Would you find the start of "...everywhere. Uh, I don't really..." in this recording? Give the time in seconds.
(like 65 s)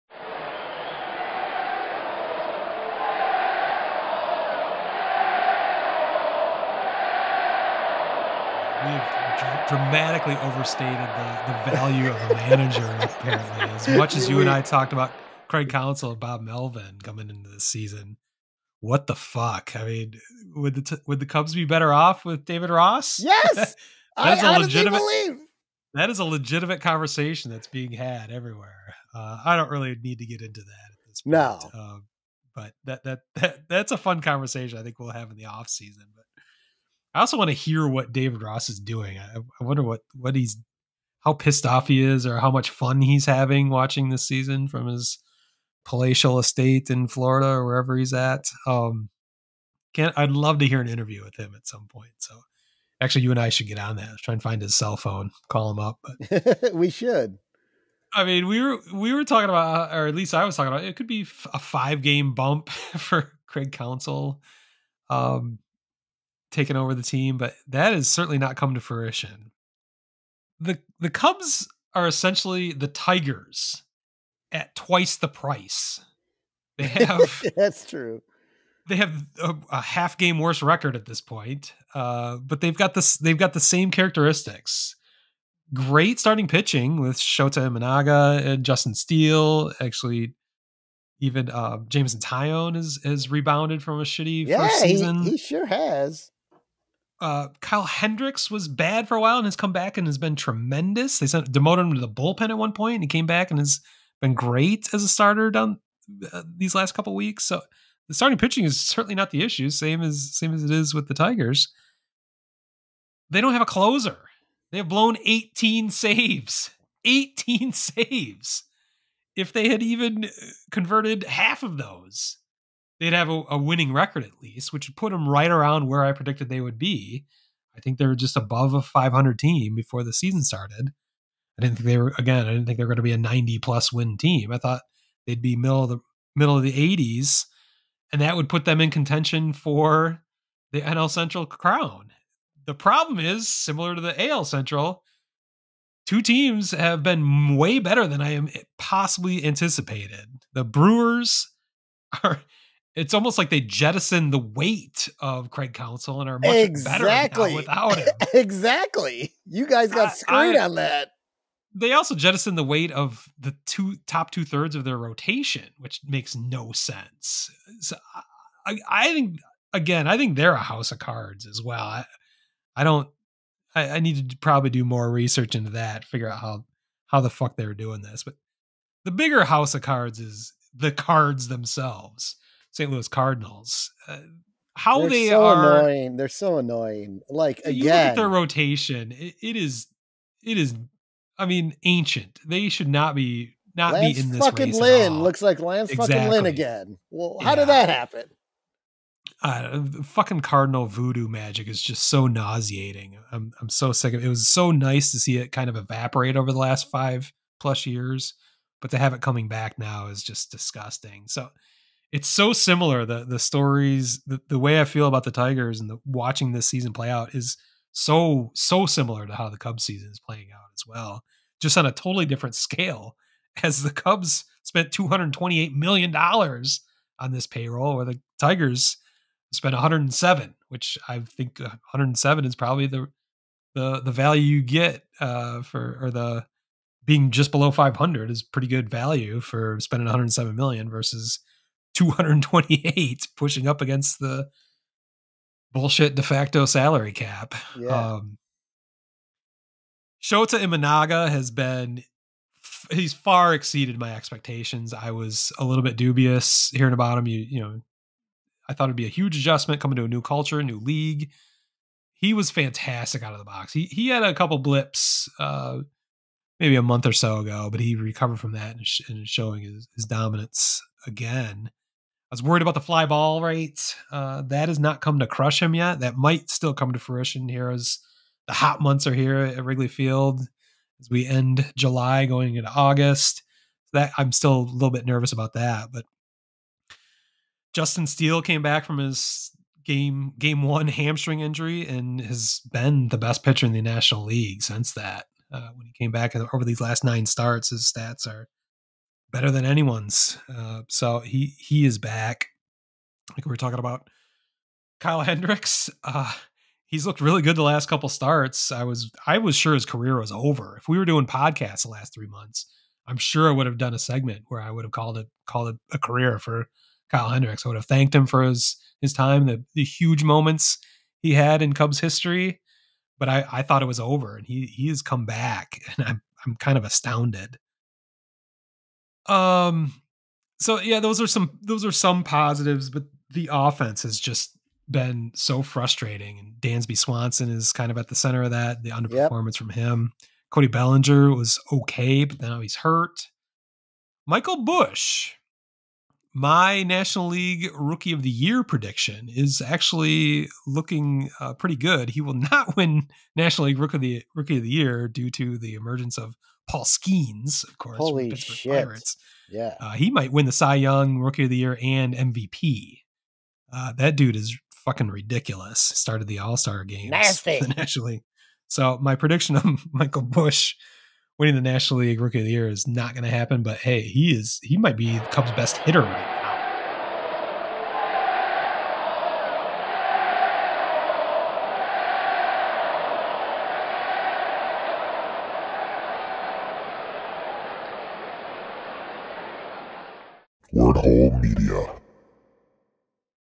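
28 s.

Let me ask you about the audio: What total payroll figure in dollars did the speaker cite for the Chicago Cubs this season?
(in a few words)
$228 million.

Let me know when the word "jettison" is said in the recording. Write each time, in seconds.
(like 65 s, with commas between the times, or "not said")
153 s, 162 s.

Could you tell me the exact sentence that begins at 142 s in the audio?
The problem is similar to the AL Central.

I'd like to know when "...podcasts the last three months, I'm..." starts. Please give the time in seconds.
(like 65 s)
311 s.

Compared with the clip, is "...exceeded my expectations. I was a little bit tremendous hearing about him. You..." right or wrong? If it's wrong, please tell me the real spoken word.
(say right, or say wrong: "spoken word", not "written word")
wrong: "dubious", not "tremendous".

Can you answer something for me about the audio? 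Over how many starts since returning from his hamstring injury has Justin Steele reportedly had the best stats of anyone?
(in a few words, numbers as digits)
9.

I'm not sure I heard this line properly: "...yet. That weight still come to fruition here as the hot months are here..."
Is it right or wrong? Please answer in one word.
wrong.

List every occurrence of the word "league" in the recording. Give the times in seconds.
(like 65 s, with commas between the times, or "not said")
260 s, 294 s, 347 s, 353 s, 372 s.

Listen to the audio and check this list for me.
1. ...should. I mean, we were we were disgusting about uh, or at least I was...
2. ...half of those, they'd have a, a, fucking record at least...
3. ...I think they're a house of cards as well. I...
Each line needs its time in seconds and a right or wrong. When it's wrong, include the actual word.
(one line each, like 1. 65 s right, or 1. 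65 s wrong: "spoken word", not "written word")
1. 56 s wrong: "talking", not "disgusting"
2. 121 s wrong: "winning", not "fucking"
3. 170 s right.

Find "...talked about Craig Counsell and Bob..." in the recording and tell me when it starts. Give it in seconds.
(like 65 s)
14 s.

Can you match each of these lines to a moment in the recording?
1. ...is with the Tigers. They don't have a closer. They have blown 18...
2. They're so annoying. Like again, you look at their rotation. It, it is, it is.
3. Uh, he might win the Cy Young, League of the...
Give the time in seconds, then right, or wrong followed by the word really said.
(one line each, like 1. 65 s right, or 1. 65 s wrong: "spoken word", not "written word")
1. 110 s right
2. 186 s right
3. 359 s wrong: "Rookie", not "League".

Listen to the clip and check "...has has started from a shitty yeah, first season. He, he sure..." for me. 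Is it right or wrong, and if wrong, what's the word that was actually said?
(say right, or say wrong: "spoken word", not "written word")
wrong: "rebounded", not "started".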